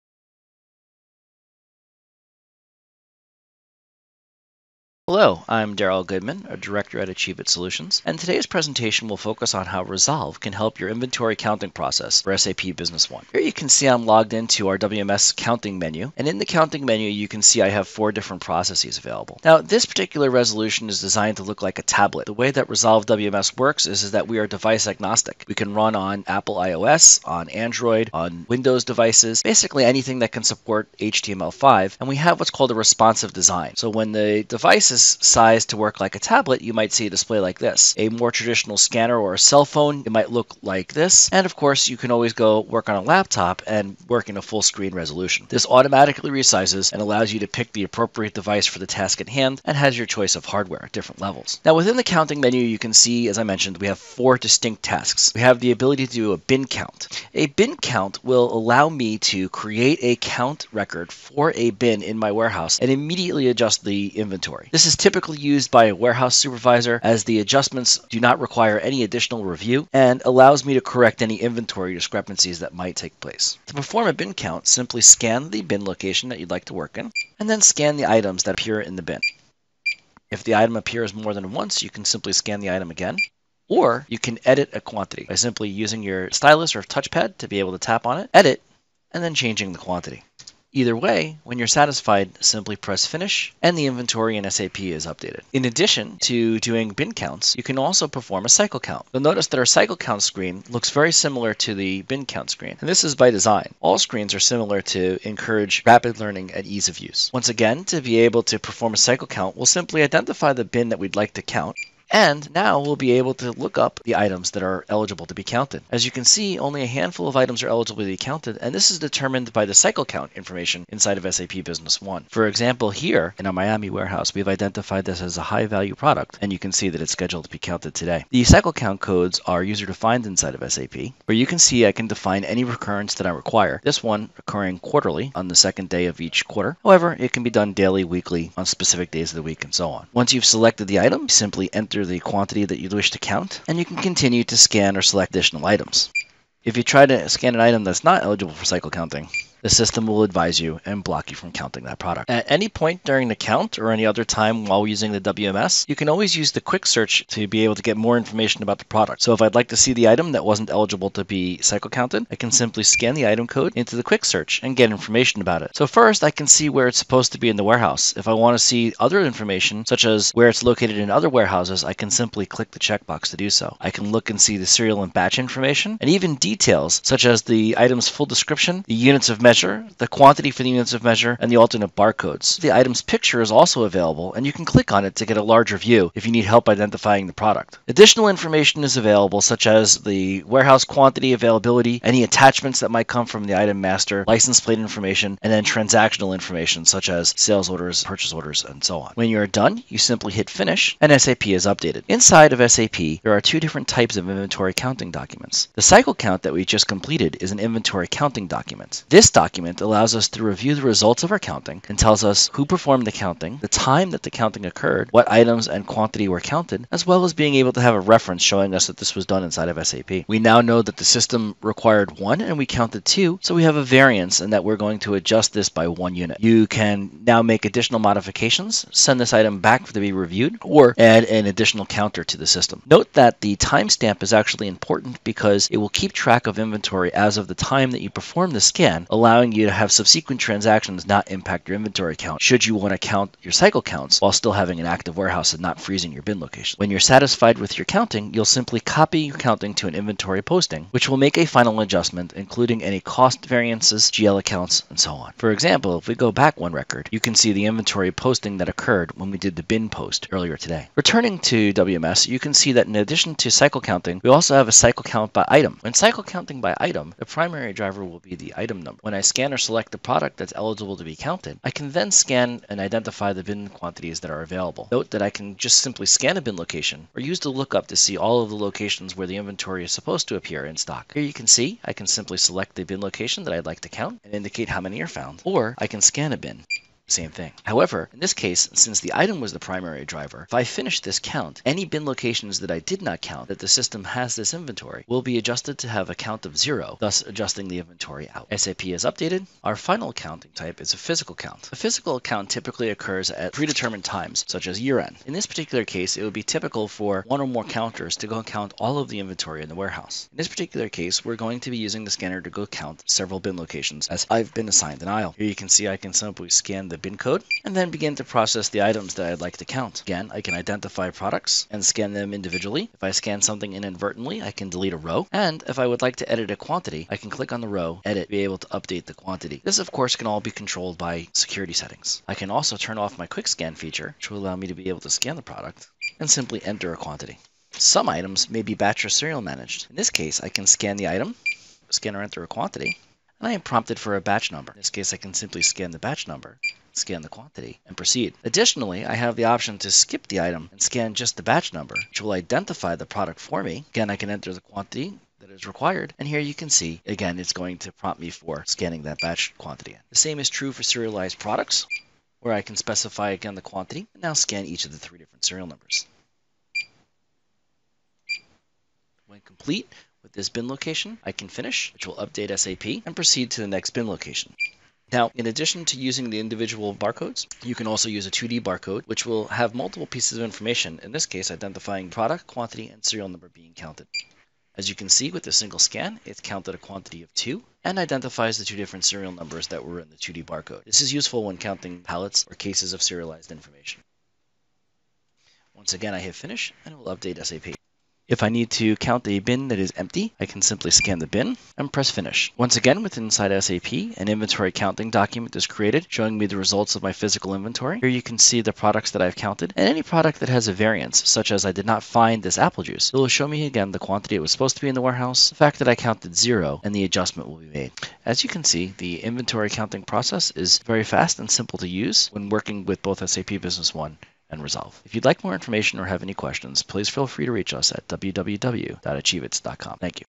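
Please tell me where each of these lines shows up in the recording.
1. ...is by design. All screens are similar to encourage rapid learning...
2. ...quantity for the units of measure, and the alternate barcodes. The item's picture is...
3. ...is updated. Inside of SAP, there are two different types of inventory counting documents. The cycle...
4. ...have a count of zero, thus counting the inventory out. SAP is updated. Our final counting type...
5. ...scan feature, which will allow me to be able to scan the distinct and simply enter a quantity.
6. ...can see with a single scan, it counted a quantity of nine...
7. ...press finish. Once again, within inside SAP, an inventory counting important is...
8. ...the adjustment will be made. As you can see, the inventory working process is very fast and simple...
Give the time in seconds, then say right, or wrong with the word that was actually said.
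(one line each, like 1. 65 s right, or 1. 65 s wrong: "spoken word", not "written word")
1. 103 s right
2. 180 s right
3. 201 s right
4. 295 s wrong: "adjusting", not "counting"
5. 333 s wrong: "product", not "distinct"
6. 384 s wrong: "two", not "nine"
7. 401 s wrong: "document", not "important"
8. 416 s wrong: "counting", not "working".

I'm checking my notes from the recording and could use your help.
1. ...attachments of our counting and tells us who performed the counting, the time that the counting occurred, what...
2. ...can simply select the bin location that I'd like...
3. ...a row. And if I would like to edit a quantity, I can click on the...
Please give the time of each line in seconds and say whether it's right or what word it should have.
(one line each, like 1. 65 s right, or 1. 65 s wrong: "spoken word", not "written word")
1. 210 s wrong: "results", not "attachments"
2. 281 s right
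3. 324 s right.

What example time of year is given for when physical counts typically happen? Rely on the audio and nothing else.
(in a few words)
Year end.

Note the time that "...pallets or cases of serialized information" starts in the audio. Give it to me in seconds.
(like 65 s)
392 s.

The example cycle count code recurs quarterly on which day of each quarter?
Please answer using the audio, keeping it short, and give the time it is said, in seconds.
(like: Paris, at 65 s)
Second day, at 135 s.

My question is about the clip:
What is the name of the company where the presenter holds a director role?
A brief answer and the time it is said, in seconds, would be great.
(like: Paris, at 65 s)
Achieve IT Solutions, at 7 s.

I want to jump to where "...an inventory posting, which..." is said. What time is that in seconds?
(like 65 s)
249 s.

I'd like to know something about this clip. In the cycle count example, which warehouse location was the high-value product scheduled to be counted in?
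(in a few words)
Miami.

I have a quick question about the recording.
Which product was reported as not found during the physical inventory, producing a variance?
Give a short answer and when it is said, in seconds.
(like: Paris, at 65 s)
Apple juice, at 412 s.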